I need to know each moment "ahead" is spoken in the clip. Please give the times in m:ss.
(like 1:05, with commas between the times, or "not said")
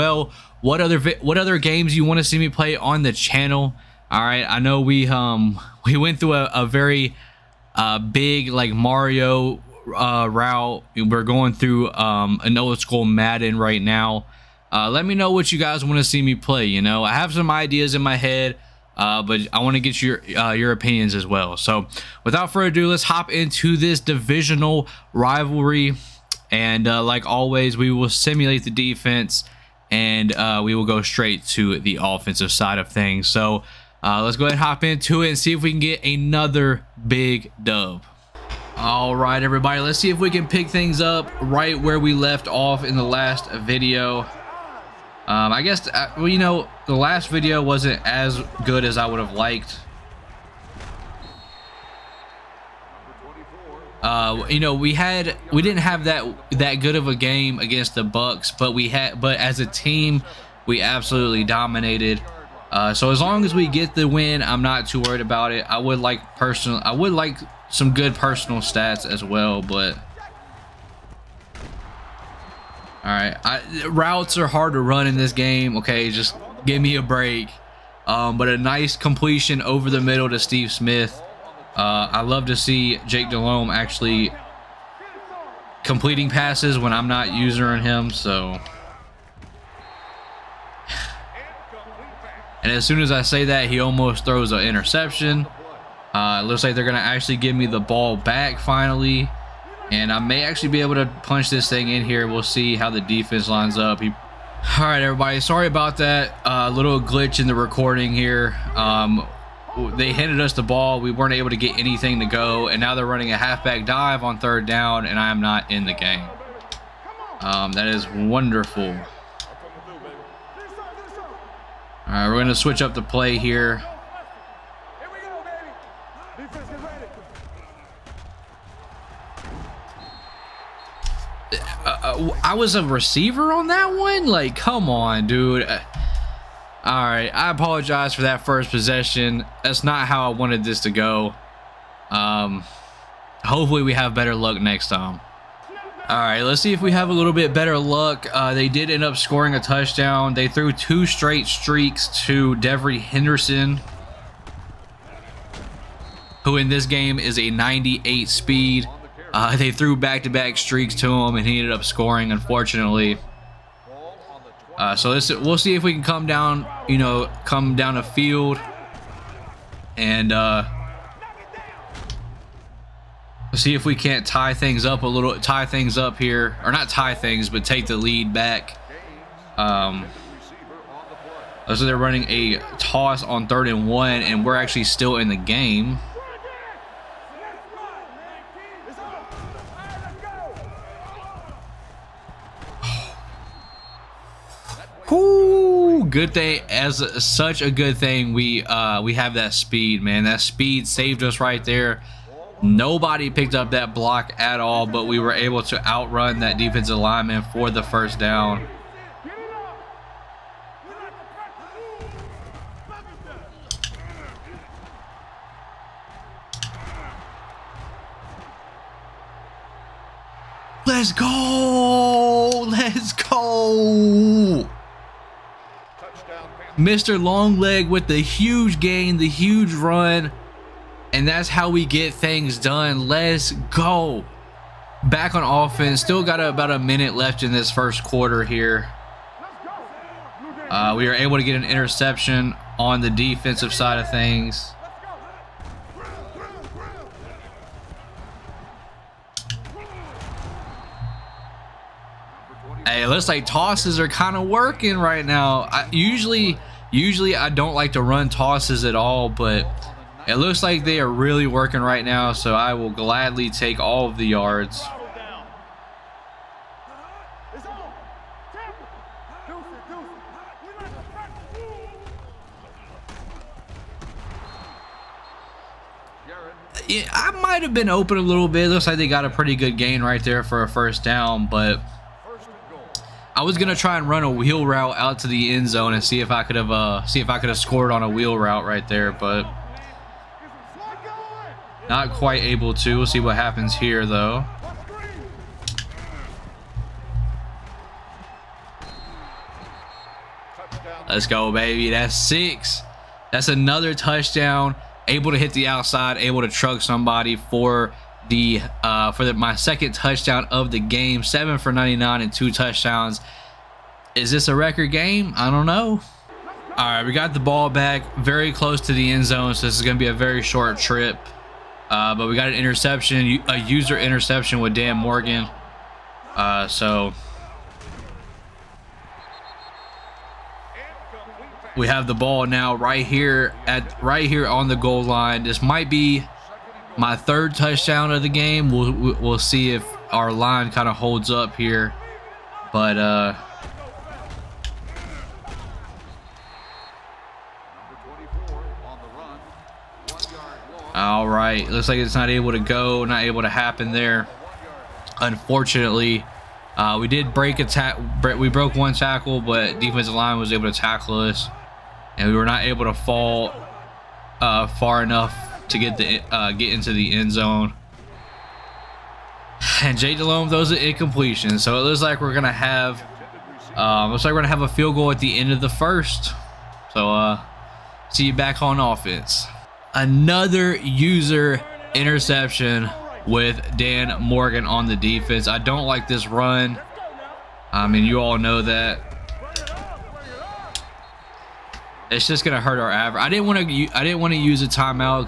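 0:34.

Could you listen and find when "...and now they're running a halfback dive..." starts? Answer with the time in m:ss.
1:52.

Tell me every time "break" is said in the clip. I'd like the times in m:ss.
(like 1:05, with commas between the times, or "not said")
1:17, 5:57.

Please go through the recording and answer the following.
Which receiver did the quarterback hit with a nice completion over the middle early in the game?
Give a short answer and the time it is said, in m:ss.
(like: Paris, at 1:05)
Steve Smith, at 1:20.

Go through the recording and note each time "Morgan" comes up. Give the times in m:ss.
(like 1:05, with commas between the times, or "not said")
5:24, 6:24.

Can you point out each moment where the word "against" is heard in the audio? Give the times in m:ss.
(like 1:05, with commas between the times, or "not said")
0:57.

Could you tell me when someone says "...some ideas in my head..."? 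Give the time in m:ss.
0:17.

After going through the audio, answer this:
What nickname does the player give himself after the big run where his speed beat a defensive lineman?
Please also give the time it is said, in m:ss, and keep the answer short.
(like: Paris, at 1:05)
Mr. Longleg, at 3:46.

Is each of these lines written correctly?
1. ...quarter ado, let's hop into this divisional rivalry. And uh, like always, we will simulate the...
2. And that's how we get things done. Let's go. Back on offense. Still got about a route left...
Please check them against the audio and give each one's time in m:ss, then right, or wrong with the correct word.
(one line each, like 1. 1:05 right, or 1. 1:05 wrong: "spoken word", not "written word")
1. 0:22 wrong: "further", not "quarter"
2. 3:51 wrong: "minute", not "route".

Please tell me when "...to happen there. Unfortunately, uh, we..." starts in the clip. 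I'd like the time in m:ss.
5:53.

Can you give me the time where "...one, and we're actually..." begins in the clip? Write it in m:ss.
3:03.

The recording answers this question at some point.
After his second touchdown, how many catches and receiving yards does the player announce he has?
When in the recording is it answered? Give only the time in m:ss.
5:11.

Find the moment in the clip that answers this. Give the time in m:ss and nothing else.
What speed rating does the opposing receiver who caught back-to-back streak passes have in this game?
2:37.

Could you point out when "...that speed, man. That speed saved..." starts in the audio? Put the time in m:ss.
3:19.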